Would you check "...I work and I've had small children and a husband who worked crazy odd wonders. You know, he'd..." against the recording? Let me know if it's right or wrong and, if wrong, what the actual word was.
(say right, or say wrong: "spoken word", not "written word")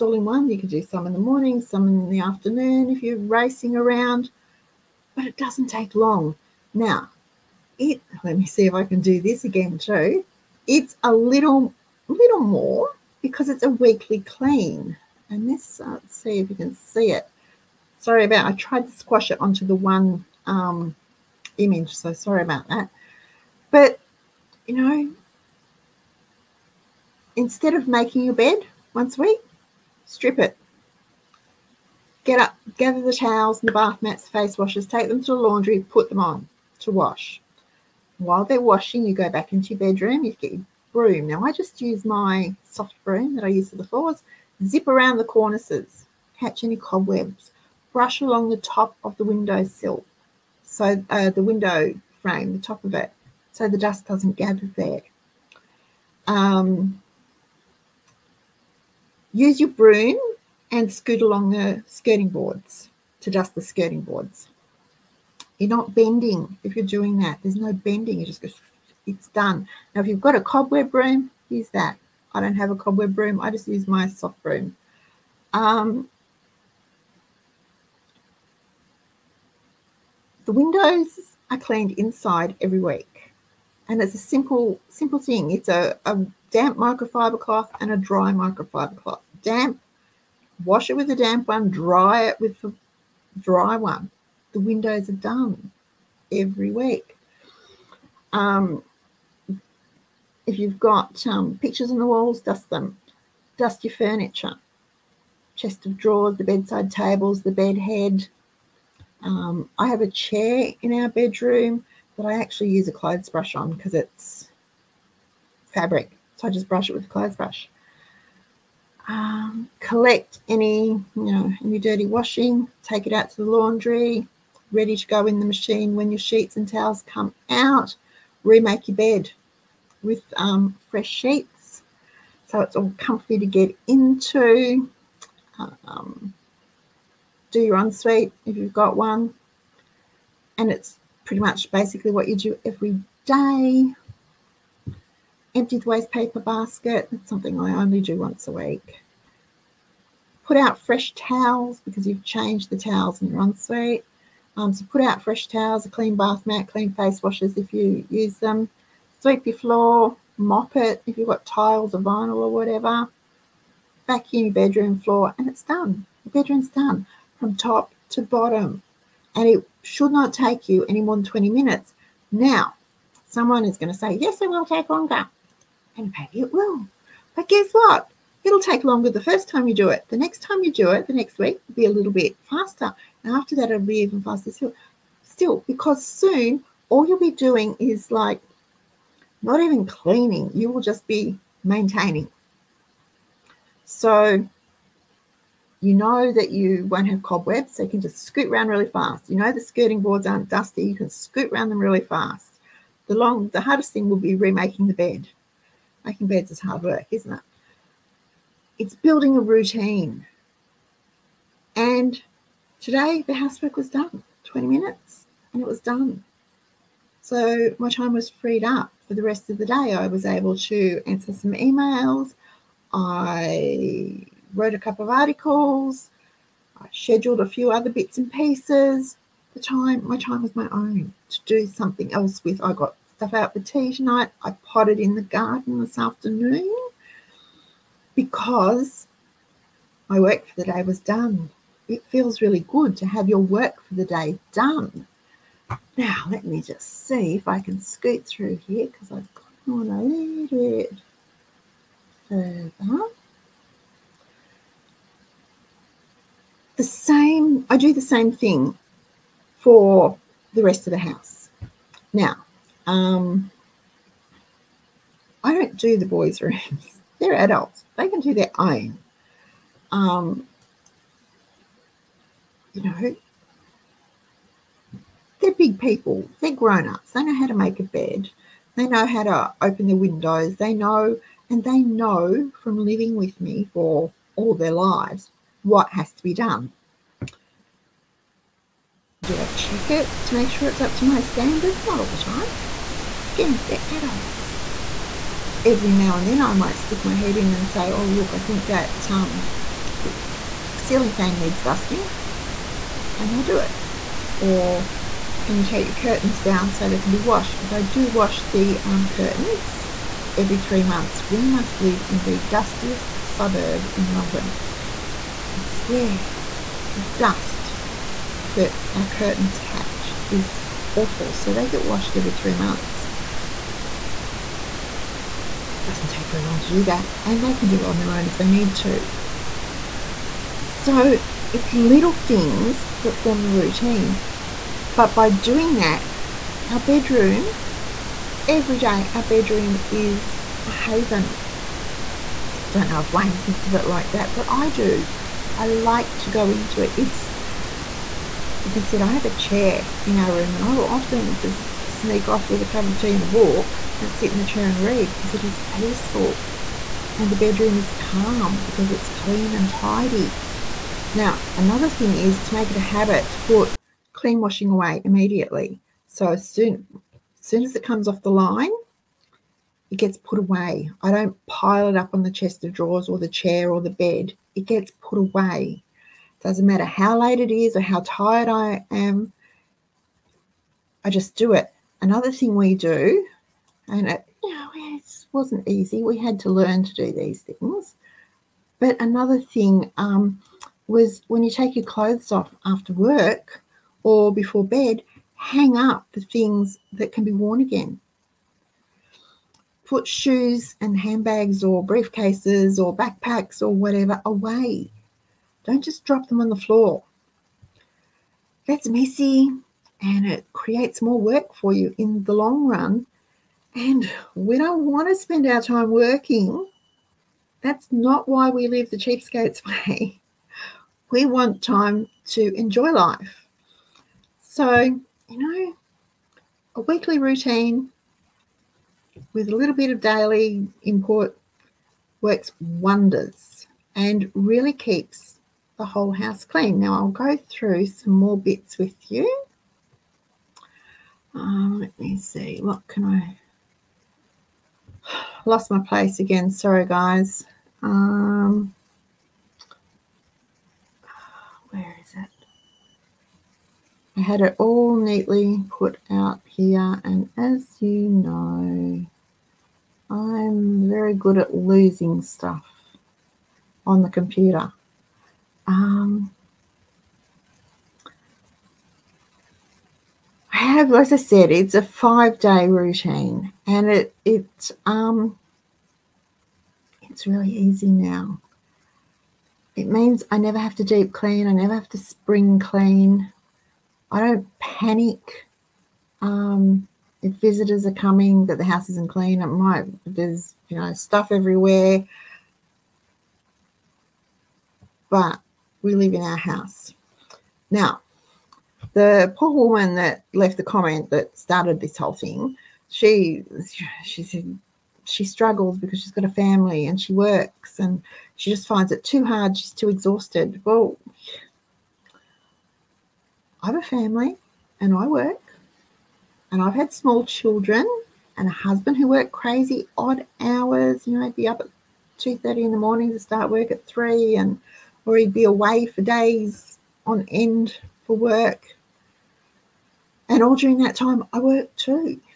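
wrong: "hours", not "wonders".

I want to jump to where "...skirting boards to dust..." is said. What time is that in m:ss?
1:01.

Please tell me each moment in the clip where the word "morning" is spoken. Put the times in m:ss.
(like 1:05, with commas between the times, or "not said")
0:01, 8:42.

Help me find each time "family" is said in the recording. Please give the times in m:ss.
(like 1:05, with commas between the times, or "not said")
8:26, 8:33.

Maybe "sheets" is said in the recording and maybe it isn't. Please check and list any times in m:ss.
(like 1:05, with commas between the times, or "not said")
2:06, 2:11.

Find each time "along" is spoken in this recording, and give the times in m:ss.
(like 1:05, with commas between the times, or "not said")
0:48, 1:01.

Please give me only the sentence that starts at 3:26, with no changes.
Making beds is hard work, isn't it?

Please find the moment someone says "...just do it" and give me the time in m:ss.
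6:21.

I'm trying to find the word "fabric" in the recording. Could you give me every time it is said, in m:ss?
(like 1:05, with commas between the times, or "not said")
1:55.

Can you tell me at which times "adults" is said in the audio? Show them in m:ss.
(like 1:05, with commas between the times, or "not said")
4:27, 4:53.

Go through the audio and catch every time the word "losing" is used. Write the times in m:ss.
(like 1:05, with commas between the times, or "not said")
7:41.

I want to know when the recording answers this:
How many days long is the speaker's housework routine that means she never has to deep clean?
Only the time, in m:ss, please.
7:51.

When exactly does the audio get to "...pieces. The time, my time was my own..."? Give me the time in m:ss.
3:48.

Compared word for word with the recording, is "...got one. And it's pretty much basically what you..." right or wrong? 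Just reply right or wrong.
right.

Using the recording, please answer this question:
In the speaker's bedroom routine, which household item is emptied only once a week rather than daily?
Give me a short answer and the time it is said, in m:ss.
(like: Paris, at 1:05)
waste paper basket, at 2:25.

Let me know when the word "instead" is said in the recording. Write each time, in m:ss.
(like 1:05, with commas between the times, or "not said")
0:27.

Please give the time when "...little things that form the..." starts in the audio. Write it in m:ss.
5:31.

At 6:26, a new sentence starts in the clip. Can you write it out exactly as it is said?
We had to learn to do these things.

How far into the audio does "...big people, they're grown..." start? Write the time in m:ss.
4:35.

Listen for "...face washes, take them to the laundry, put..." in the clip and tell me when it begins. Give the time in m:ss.
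0:34.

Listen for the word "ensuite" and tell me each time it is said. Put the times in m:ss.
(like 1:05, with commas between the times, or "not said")
2:17, 2:33.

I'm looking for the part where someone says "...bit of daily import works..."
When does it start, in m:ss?
7:09.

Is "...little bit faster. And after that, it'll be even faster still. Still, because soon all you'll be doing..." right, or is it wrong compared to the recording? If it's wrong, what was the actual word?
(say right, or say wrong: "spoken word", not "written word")
right.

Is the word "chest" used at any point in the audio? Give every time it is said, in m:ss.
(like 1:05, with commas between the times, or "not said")
1:45, 6:12.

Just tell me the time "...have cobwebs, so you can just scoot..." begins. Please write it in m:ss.
3:17.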